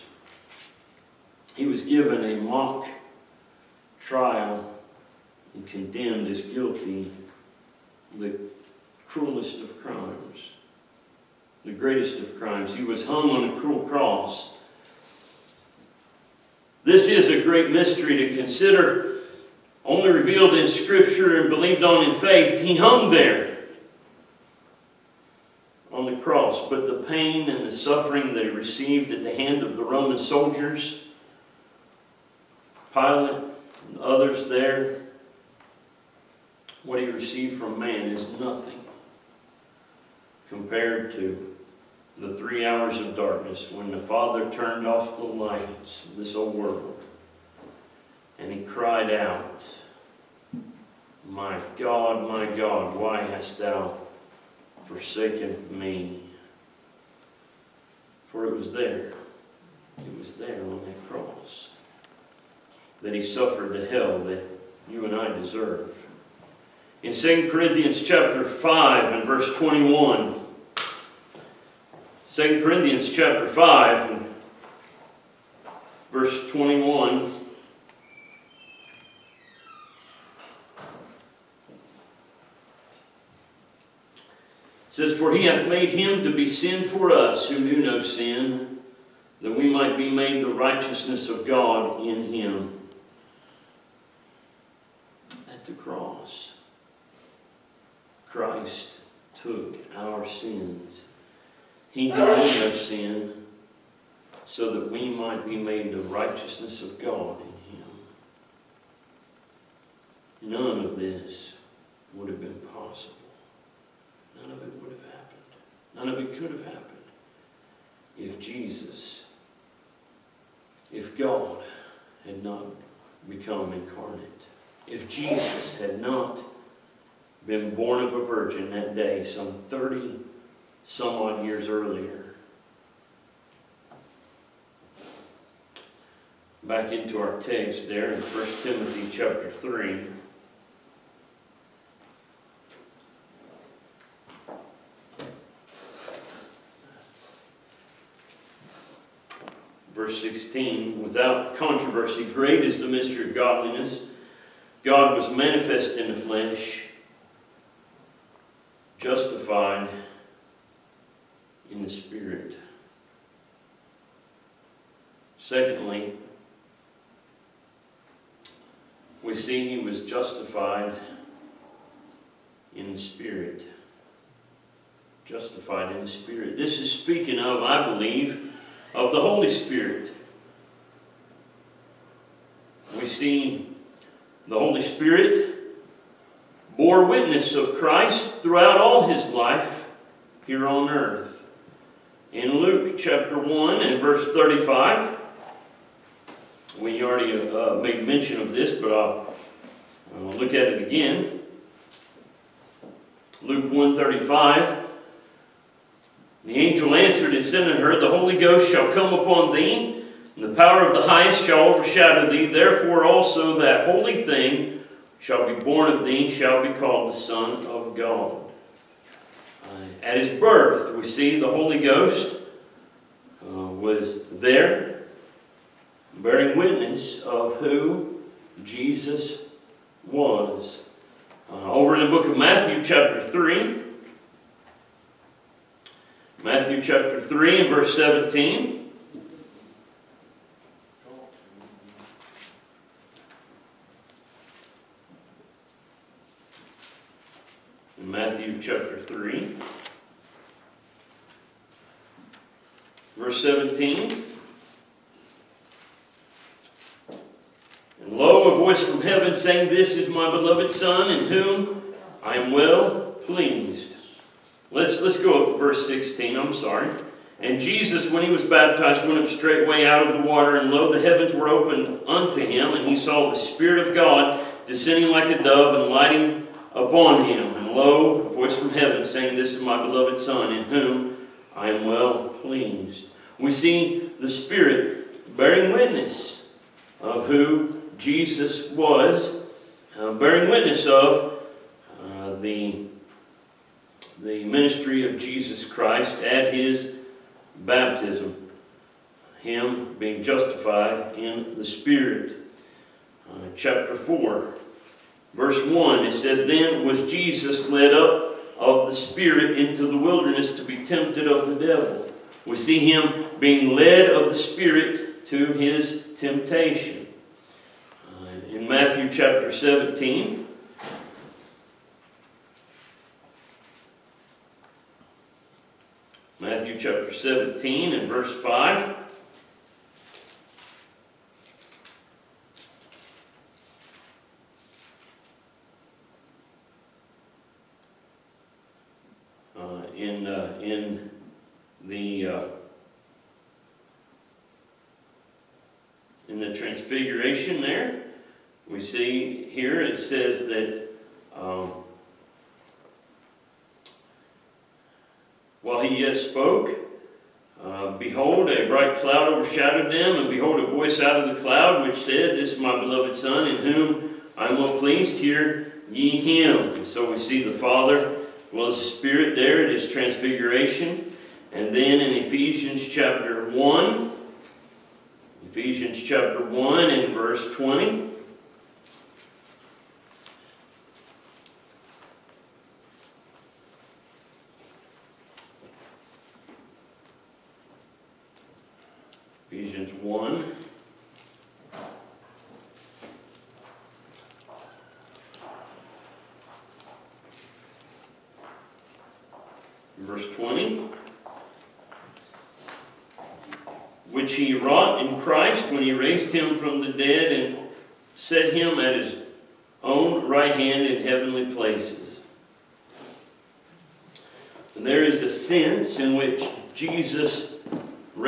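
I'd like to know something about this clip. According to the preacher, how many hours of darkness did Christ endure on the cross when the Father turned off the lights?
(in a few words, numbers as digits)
3.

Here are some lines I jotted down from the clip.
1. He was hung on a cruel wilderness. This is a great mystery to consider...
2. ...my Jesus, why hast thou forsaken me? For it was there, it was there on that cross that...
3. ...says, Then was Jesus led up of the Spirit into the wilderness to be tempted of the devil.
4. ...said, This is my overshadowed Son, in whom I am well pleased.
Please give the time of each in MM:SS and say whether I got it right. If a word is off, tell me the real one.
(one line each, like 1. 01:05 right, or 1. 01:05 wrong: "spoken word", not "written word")
1. 00:12 wrong: "cross", not "wilderness"
2. 00:52 wrong: "God", not "Jesus"
3. 05:06 right
4. 06:01 wrong: "beloved", not "overshadowed".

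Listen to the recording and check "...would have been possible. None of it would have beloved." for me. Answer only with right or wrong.
wrong.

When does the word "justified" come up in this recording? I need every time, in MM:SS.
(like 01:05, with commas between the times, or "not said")
02:38, 02:50, 02:55, 05:00.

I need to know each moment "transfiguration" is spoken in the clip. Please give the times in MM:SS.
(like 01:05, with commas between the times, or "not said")
05:46, 06:09.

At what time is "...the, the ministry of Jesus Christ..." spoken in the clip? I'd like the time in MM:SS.
04:52.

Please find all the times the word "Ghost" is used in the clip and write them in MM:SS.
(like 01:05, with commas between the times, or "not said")
03:28, 03:41.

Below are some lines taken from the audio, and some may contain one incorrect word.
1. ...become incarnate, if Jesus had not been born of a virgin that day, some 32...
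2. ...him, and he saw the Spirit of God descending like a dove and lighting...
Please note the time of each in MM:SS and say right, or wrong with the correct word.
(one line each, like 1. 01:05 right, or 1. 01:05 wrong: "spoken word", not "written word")
1. 02:03 wrong: "30", not "32"
2. 04:32 right.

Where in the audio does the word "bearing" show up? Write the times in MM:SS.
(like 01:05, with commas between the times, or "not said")
03:46, 04:45, 04:50.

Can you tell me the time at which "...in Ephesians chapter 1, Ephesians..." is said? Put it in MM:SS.
06:11.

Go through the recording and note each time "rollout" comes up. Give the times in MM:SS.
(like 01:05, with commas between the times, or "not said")
not said.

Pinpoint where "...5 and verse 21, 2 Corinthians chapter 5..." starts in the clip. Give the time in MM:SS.
01:08.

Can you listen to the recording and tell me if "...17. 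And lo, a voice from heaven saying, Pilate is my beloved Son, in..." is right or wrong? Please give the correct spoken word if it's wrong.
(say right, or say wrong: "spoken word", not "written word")
wrong: "This", not "Pilate".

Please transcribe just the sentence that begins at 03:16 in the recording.
We already uh, made mention of this, but I'll, I'll look at it again.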